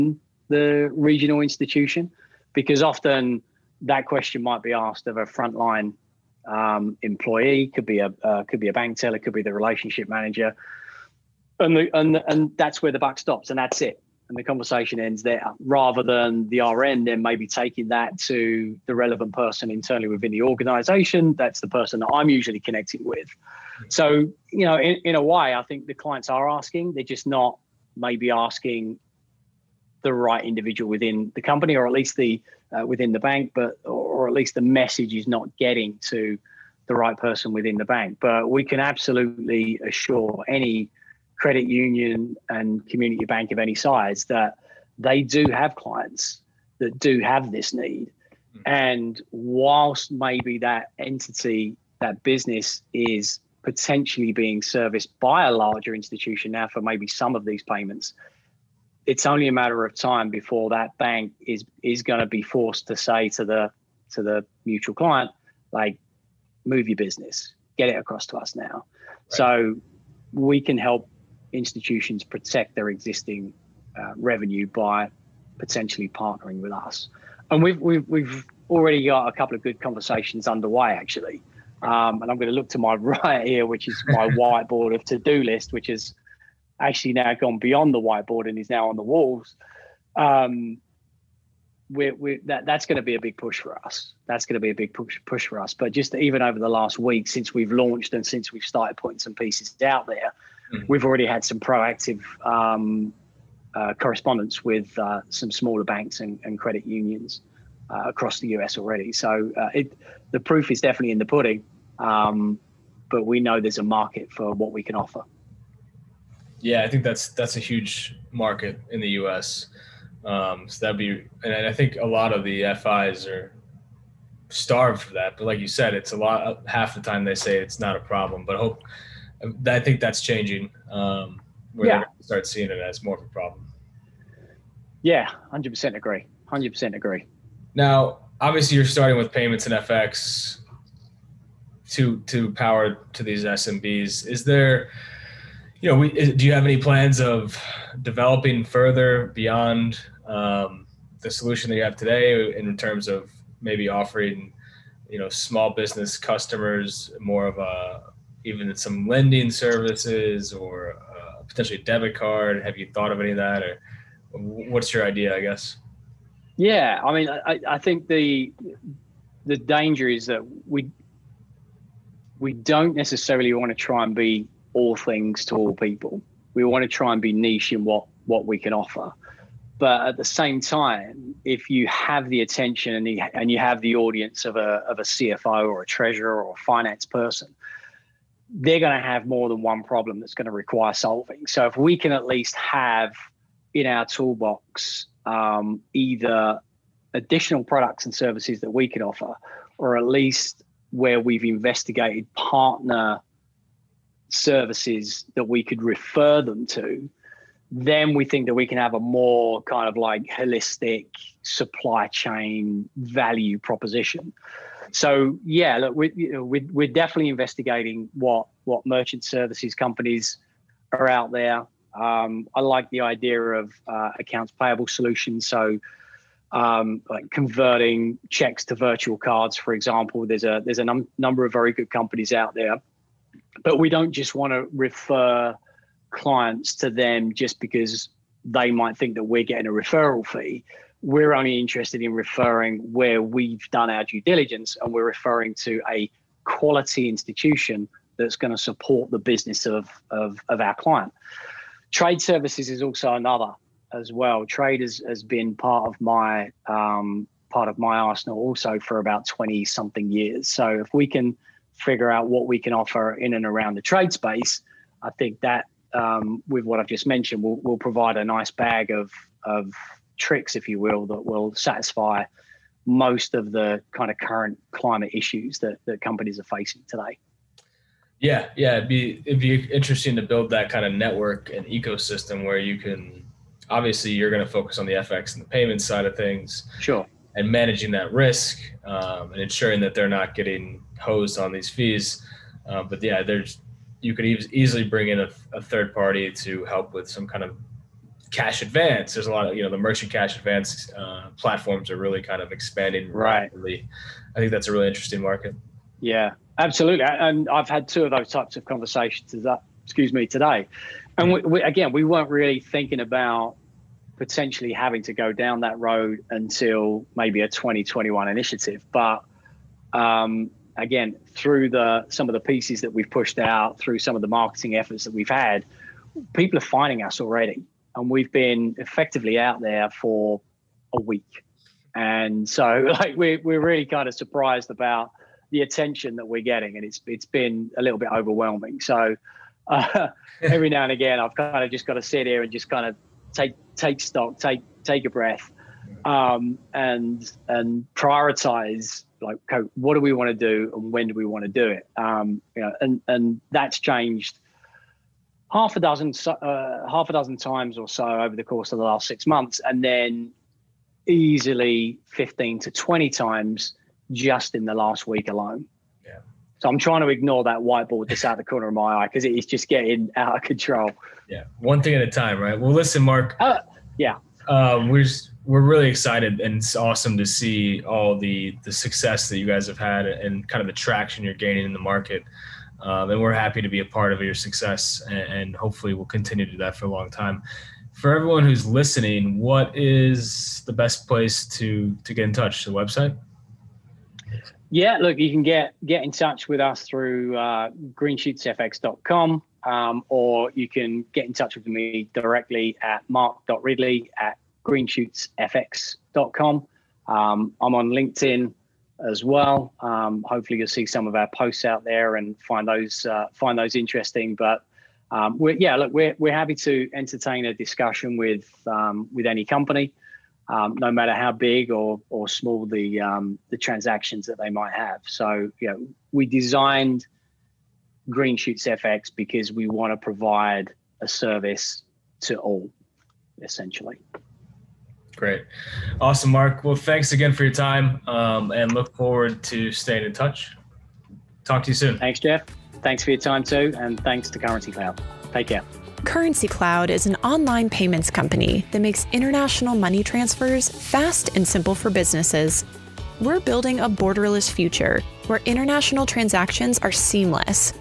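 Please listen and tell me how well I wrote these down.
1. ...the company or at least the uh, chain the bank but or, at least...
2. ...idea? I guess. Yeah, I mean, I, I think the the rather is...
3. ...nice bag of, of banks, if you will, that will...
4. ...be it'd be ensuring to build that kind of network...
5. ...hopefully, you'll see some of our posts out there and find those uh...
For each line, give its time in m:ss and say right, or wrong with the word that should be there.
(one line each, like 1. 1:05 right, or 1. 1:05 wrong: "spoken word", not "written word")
1. 0:31 wrong: "within", not "chain"
2. 2:45 wrong: "danger", not "rather"
3. 4:28 wrong: "tricks", not "banks"
4. 4:38 wrong: "interesting", not "ensuring"
5. 6:50 right.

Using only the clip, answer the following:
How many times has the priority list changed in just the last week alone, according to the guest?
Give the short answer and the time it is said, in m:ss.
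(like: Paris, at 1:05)
15 to 20 times, at 6:02.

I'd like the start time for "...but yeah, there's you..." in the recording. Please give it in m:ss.
4:52.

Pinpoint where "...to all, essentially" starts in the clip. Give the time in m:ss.
7:12.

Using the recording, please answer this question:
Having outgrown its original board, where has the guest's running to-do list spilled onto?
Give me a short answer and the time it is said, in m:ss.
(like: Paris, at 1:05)
The walls, at 1:28.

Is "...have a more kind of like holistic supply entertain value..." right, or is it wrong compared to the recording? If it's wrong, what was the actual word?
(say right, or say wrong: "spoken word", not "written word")
wrong: "chain", not "entertain".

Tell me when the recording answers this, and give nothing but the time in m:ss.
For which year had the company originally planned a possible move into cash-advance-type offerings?
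5:17.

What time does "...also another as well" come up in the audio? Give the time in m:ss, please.
4:12.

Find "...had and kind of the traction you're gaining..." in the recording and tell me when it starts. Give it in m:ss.
6:19.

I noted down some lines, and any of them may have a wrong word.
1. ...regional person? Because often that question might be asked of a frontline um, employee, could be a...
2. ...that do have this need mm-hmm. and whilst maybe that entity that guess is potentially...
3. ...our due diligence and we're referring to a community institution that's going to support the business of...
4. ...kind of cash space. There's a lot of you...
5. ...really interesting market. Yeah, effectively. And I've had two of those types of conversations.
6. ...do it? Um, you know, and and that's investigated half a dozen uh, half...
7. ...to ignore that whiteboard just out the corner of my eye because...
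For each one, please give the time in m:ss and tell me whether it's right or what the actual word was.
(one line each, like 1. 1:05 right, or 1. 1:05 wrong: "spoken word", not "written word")
1. 0:00 wrong: "institution", not "person"
2. 0:46 wrong: "business", not "guess"
3. 4:03 wrong: "quality", not "community"
4. 4:57 wrong: "advance", not "space"
5. 5:04 wrong: "absolutely", not "effectively"
6. 5:51 wrong: "changed", not "investigated"
7. 6:07 right.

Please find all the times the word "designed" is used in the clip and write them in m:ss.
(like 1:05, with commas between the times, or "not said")
7:06.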